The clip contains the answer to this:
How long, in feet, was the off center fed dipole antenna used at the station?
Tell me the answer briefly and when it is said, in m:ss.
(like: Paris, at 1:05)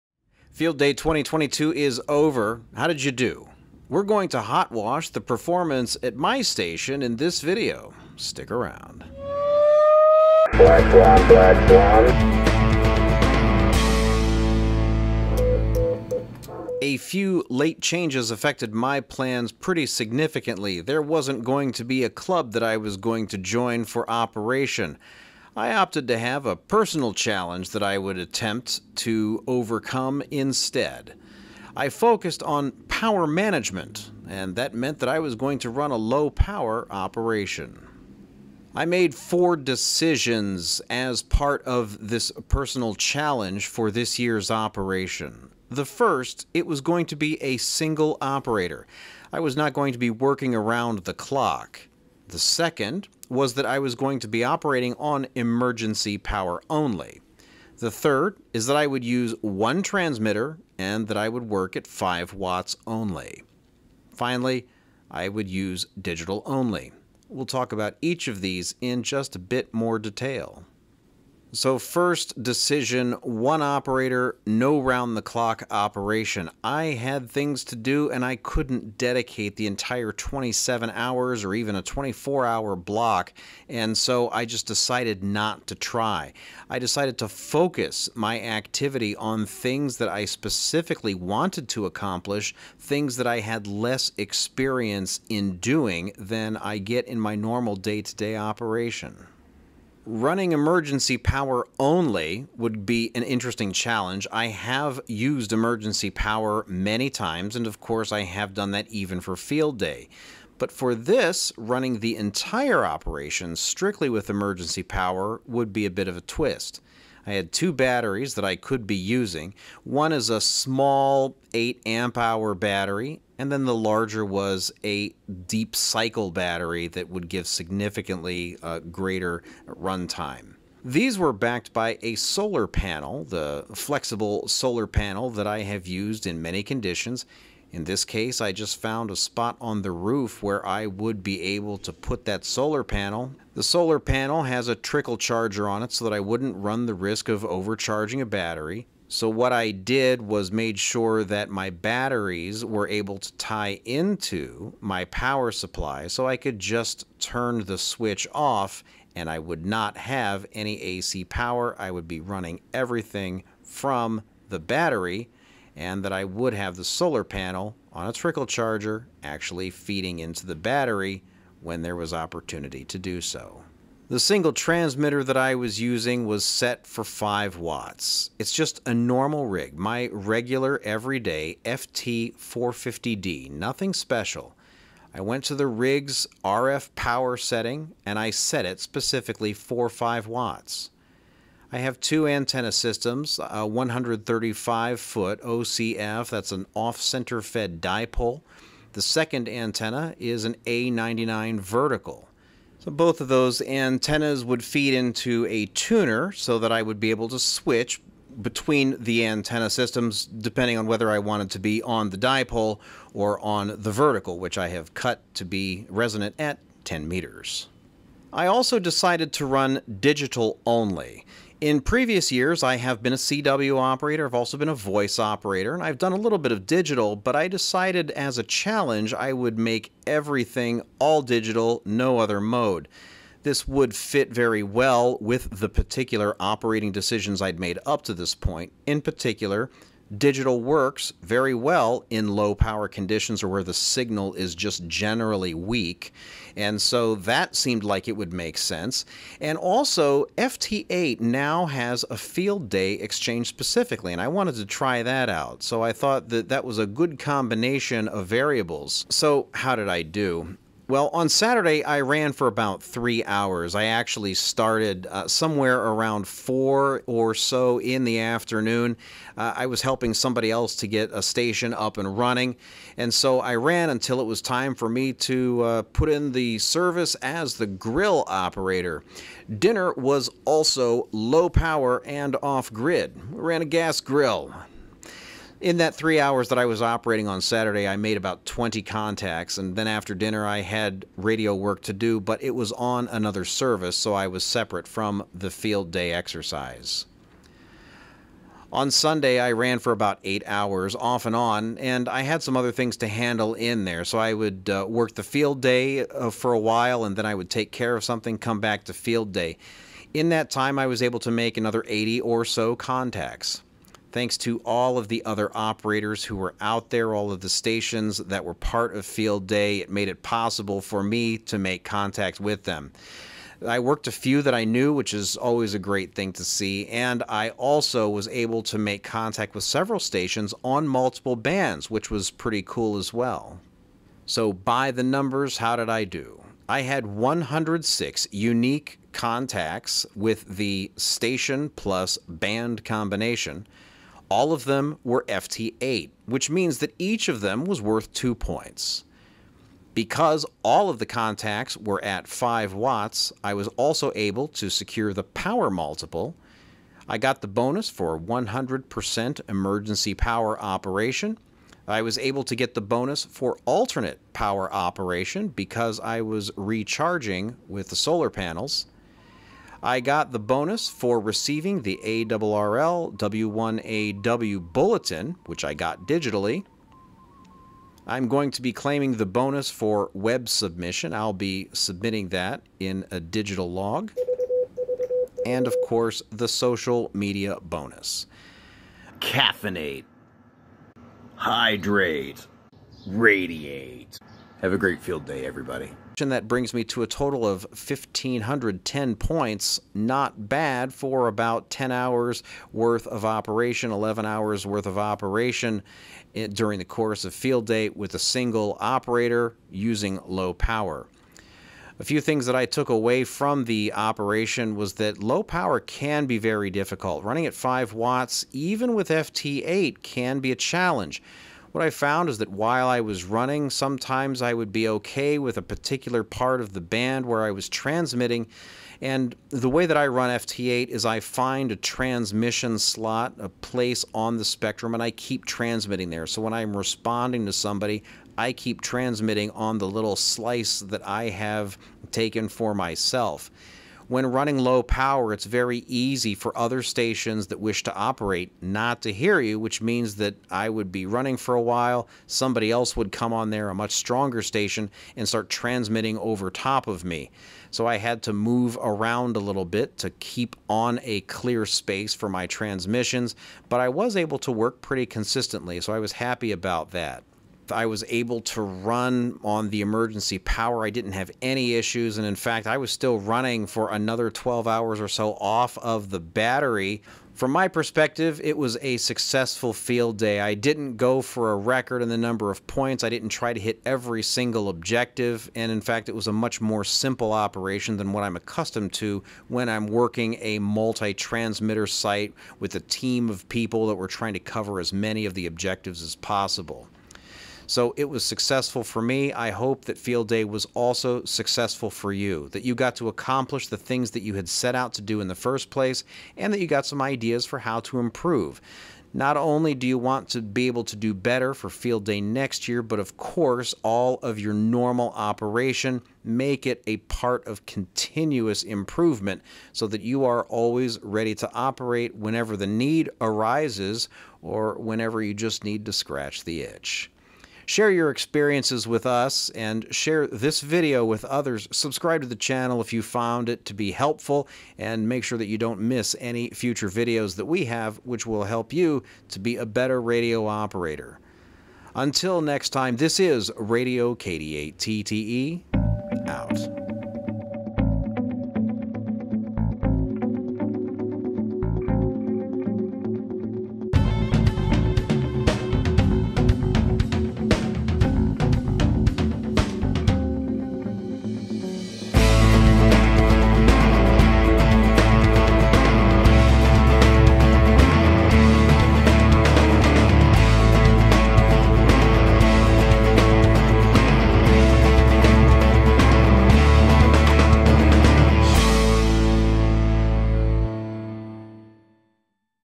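135 feet, at 3:13.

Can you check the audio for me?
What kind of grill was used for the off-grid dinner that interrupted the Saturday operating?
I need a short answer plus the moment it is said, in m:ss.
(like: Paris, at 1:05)
gas grill, at 4:43.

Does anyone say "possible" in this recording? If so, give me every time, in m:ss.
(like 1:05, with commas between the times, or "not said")
5:20, 8:16.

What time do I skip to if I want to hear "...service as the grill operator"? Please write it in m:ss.
4:36.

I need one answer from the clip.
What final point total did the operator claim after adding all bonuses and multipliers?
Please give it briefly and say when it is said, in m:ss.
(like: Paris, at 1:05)
1,510 points, at 6:37.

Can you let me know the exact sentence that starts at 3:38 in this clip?
I also decided to run digital only.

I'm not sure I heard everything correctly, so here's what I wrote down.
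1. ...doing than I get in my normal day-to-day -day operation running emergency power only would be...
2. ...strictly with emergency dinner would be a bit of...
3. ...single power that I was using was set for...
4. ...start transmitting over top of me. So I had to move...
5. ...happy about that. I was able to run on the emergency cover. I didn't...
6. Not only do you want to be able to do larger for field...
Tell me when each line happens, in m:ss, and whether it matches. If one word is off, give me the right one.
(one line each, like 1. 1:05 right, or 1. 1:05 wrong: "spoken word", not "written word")
1. 1:35 right
2. 1:53 wrong: "power", not "dinner"
3. 2:54 wrong: "transmitter", not "power"
4. 7:35 right
5. 7:46 wrong: "power", not "cover"
6. 8:29 wrong: "better", not "larger".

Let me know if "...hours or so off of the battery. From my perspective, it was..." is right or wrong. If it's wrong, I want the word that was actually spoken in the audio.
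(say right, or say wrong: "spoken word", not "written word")
right.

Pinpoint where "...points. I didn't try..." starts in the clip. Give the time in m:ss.
8:02.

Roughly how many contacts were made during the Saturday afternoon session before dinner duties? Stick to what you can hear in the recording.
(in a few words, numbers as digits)
20.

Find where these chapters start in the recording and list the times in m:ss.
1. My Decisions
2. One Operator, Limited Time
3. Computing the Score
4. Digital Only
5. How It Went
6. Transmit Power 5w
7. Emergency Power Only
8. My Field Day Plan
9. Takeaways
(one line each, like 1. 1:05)
1. 0:38
2. 1:11
3. 5:34
4. 3:38
5. 4:19
6. 2:53
7. 1:39
8. 0:16
9. 6:52.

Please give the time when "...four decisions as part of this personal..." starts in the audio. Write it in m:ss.
0:39.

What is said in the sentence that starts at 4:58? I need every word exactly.
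On Sunday, I ran for about eight hours off and on, and I had some other things to handle in there.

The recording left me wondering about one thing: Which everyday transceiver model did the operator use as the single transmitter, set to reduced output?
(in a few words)
FT450D.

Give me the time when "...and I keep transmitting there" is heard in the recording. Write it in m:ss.
7:14.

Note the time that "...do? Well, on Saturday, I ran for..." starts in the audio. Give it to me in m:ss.
4:20.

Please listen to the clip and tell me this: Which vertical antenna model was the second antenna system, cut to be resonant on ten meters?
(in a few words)
A99.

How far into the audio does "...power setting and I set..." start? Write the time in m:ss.
3:06.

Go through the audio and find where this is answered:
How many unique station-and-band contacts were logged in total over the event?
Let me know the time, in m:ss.
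5:37.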